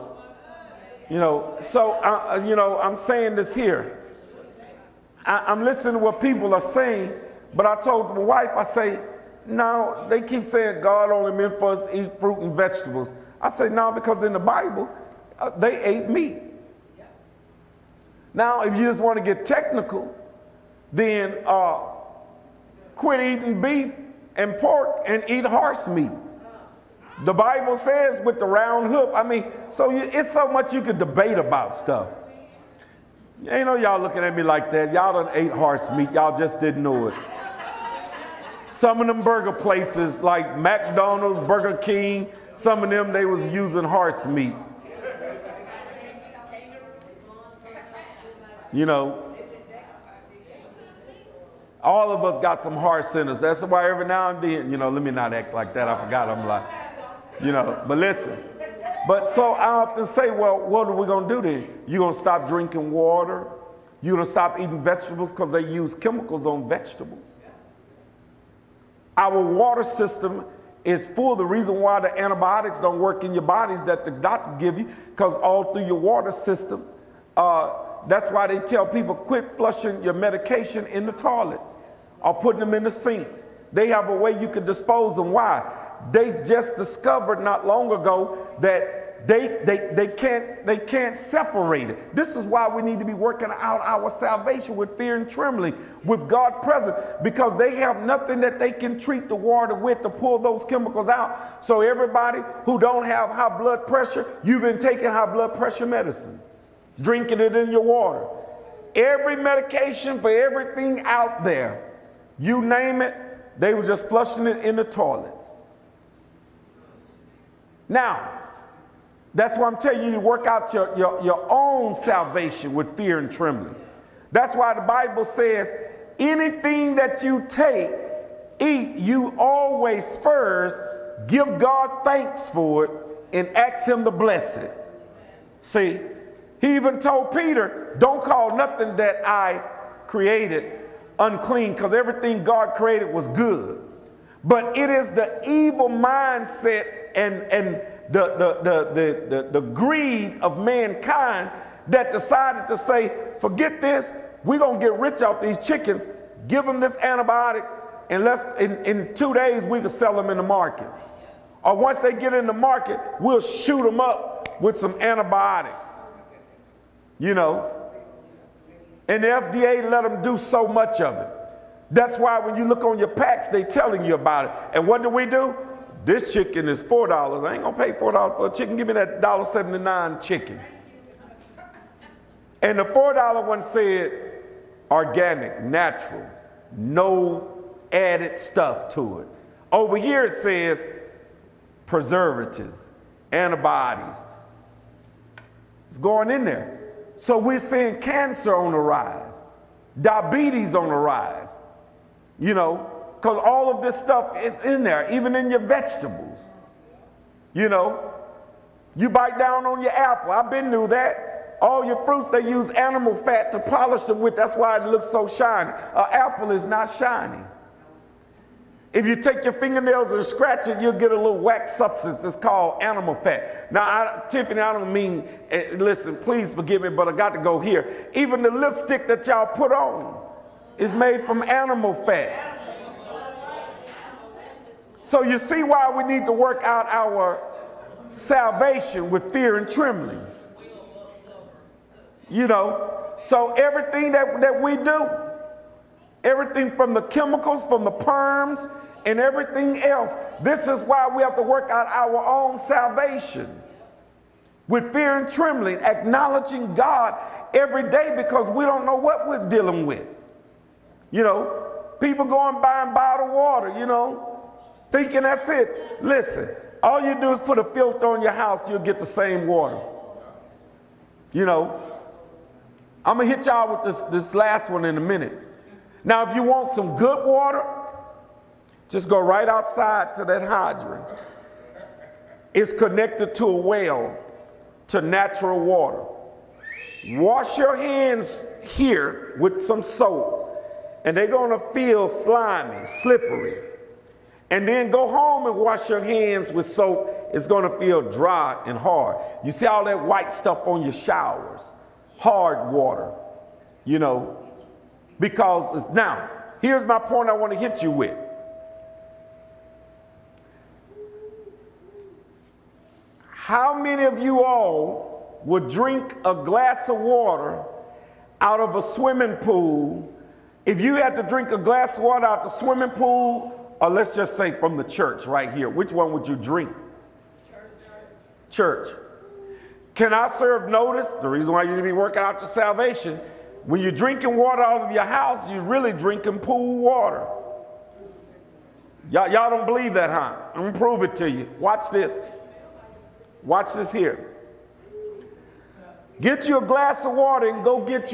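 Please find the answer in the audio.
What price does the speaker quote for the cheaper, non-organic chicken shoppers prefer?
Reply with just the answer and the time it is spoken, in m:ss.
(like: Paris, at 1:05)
$1.79, at 2:59.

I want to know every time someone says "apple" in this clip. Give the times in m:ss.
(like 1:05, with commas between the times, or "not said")
3:29, 3:36.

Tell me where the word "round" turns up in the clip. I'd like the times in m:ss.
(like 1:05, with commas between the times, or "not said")
0:28.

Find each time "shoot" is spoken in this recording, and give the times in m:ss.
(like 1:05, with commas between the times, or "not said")
2:43.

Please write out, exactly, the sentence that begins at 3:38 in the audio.
If you take your fingernails and scratch it, you'll get a little wax substance.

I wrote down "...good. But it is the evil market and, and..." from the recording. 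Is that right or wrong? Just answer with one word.
wrong.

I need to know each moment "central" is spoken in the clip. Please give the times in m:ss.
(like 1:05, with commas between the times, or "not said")
not said.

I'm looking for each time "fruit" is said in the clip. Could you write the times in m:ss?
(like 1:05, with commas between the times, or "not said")
0:12, 3:32.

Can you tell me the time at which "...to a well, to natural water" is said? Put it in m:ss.
4:43.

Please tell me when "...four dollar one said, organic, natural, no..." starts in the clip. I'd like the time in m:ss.
3:02.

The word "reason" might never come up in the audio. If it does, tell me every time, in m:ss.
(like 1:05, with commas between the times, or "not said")
1:11, 5:31.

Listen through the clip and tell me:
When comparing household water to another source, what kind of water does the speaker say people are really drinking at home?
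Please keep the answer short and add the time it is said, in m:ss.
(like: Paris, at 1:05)
pool water, at 5:36.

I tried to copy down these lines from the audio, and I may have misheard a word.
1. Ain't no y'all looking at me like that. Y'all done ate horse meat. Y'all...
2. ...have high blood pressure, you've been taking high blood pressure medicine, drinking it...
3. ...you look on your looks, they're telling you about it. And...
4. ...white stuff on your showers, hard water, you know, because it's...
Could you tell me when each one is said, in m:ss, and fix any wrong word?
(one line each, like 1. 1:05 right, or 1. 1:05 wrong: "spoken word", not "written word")
1. 0:33 right
2. 1:43 right
3. 2:52 wrong: "packs", not "looks"
4. 5:00 right.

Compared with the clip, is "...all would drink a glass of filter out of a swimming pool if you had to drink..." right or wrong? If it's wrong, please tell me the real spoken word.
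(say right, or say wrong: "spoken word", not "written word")
wrong: "water", not "filter".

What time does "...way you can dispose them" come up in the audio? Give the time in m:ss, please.
1:24.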